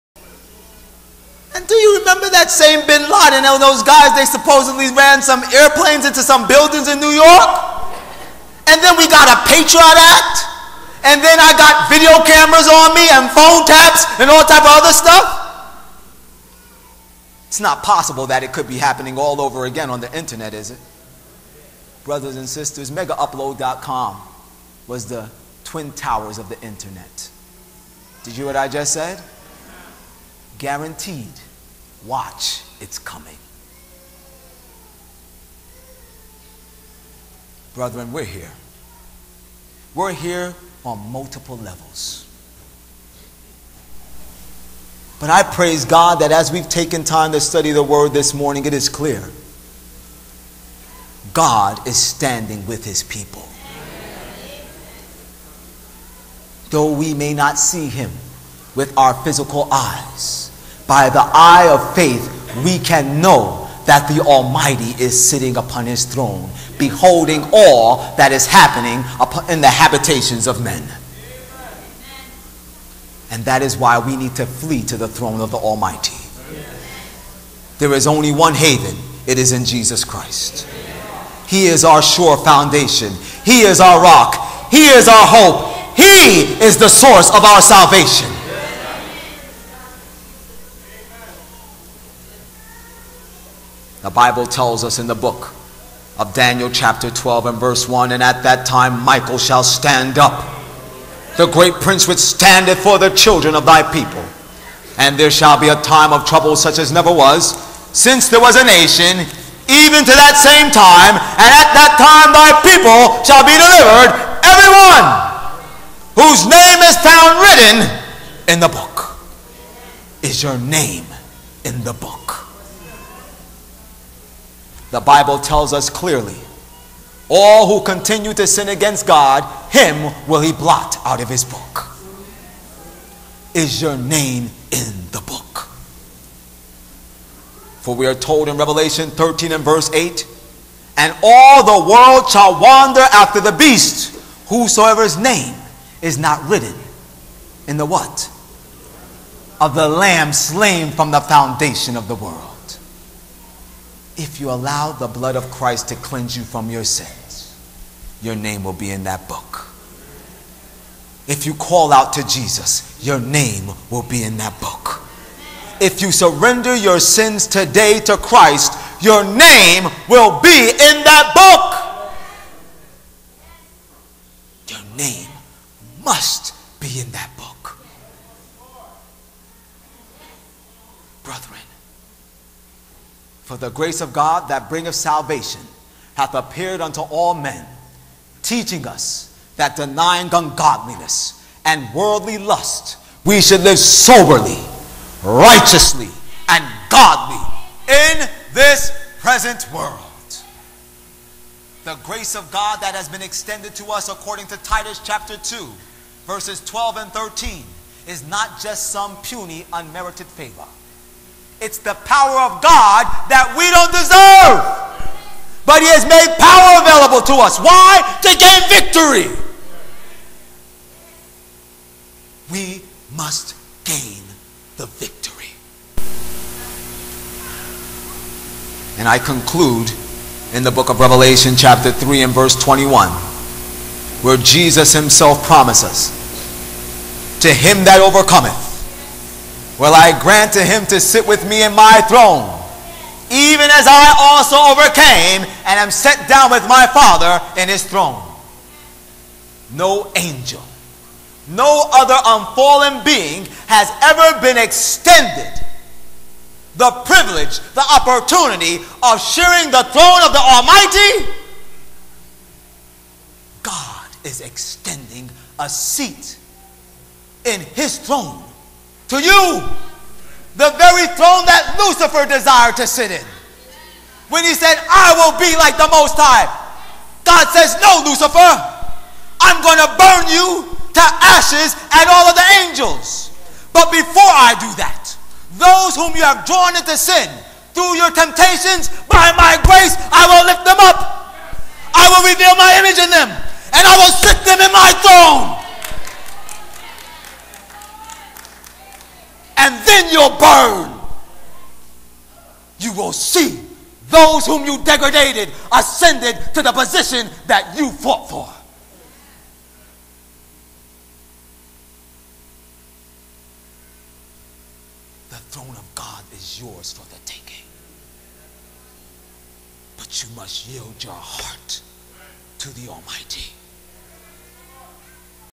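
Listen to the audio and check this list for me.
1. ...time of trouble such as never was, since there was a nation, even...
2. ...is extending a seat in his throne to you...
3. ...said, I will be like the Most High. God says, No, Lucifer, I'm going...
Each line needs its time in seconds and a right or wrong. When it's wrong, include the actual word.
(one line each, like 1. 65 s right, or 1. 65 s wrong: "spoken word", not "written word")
1. 105 s right
2. 264 s right
3. 274 s right.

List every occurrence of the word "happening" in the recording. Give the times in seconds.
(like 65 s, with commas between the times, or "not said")
18 s, 68 s.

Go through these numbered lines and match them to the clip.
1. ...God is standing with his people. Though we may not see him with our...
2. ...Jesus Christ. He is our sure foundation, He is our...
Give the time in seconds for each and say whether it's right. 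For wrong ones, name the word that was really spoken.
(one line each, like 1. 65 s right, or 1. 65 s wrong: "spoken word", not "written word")
1. 51 s right
2. 79 s right.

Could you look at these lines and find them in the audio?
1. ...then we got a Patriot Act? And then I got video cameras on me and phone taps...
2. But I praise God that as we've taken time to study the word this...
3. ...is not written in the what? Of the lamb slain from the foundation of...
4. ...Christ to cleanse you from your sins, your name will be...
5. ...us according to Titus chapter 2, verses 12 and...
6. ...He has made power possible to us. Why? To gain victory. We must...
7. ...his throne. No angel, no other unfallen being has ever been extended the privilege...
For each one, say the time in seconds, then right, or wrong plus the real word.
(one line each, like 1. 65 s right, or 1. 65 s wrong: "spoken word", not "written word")
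1. 8 s right
2. 45 s right
3. 146 s right
4. 155 s right
5. 203 s right
6. 215 s wrong: "available", not "possible"
7. 247 s right.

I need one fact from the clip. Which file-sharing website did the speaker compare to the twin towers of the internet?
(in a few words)
megaupload.com.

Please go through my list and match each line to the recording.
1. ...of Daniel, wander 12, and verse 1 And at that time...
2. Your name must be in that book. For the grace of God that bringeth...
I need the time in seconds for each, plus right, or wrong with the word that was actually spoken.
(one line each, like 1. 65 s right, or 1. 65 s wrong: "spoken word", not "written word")
1. 96 s wrong: "chapter", not "wander"
2. 174 s right.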